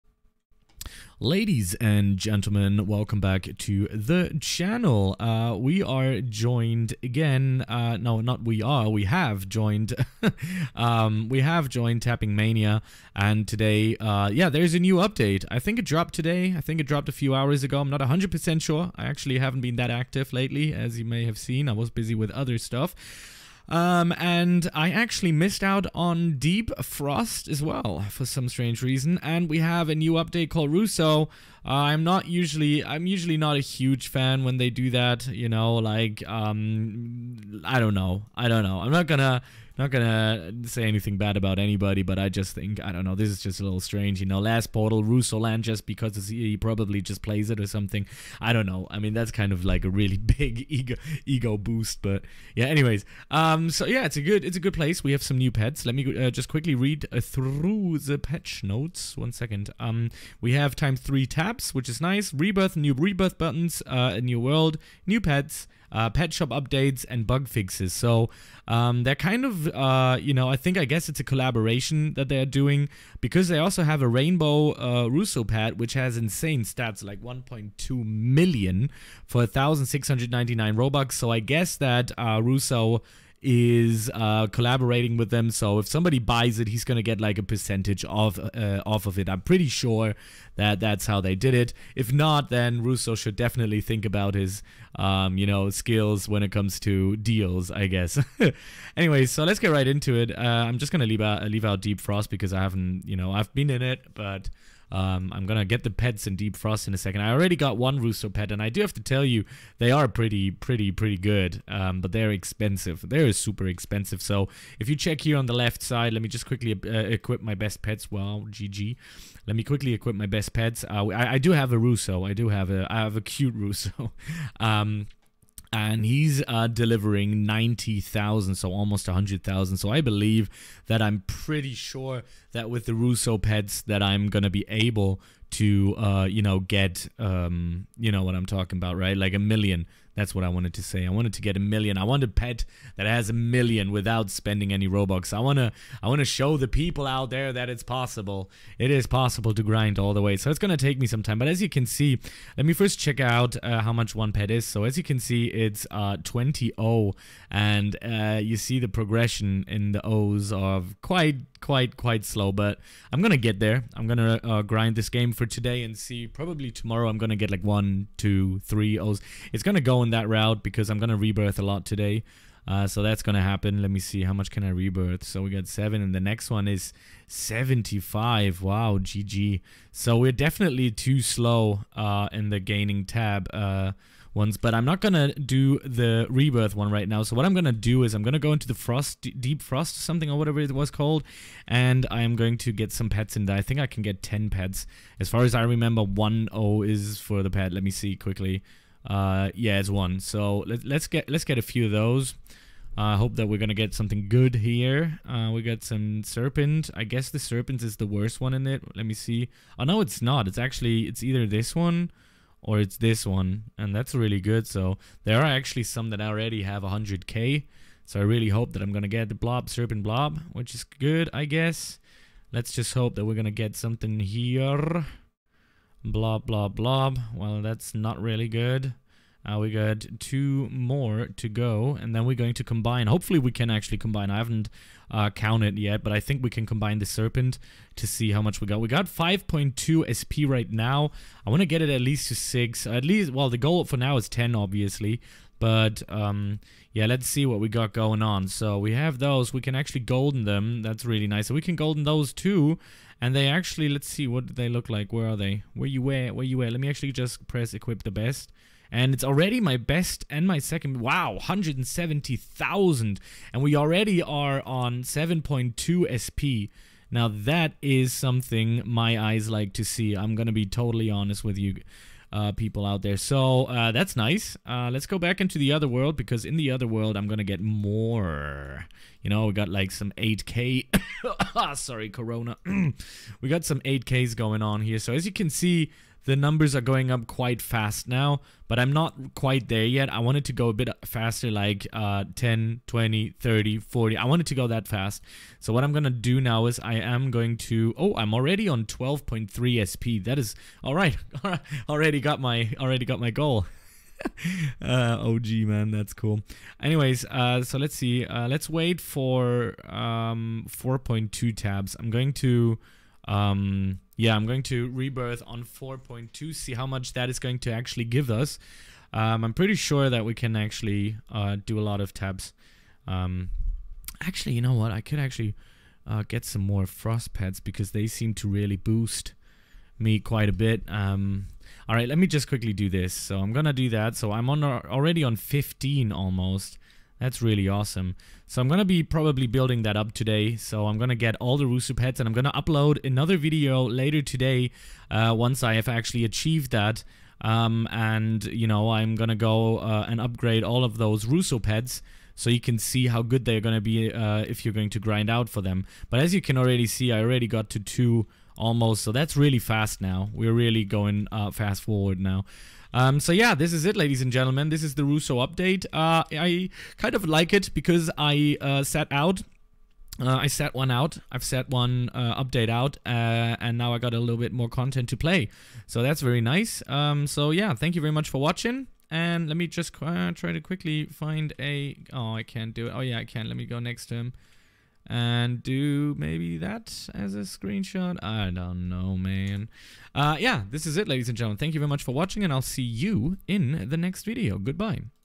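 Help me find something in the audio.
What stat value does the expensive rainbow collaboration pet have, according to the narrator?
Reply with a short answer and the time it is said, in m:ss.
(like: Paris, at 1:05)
1.2 million, at 1:17.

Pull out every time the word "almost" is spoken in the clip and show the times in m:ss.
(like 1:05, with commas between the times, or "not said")
2:08, 5:36, 5:58.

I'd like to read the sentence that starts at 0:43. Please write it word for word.
This is just a little strange, you know.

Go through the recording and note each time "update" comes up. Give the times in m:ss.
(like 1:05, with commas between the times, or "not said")
0:14, 0:30, 1:06, 6:05, 6:12.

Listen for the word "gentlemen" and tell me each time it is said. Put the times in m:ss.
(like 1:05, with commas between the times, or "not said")
0:02, 6:04, 6:31.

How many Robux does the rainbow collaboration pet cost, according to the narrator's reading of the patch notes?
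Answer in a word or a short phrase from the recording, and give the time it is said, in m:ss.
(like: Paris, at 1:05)
1,699, at 1:19.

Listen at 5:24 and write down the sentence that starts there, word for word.
I could actually uh, get some more frost pads because they seem to really boost me quite a bit.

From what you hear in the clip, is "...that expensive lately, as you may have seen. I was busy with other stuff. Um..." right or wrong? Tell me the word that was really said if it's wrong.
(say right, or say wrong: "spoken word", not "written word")
wrong: "active", not "expensive".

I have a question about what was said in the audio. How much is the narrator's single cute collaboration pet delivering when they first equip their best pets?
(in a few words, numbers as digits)
90,000.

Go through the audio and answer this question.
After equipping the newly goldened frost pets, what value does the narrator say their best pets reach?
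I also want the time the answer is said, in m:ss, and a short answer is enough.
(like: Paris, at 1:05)
170,000, at 4:21.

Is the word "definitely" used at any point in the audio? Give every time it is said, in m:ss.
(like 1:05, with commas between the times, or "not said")
1:33, 3:00.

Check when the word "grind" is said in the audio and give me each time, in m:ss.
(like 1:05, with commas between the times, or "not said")
2:29, 2:44, 5:54.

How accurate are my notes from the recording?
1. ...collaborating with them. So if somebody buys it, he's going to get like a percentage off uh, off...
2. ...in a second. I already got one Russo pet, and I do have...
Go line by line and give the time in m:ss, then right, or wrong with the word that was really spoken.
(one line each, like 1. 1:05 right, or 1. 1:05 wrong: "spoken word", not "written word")
1. 1:24 right
2. 1:46 right.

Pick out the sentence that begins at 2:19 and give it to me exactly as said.
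Like a million that's what I wanted to say.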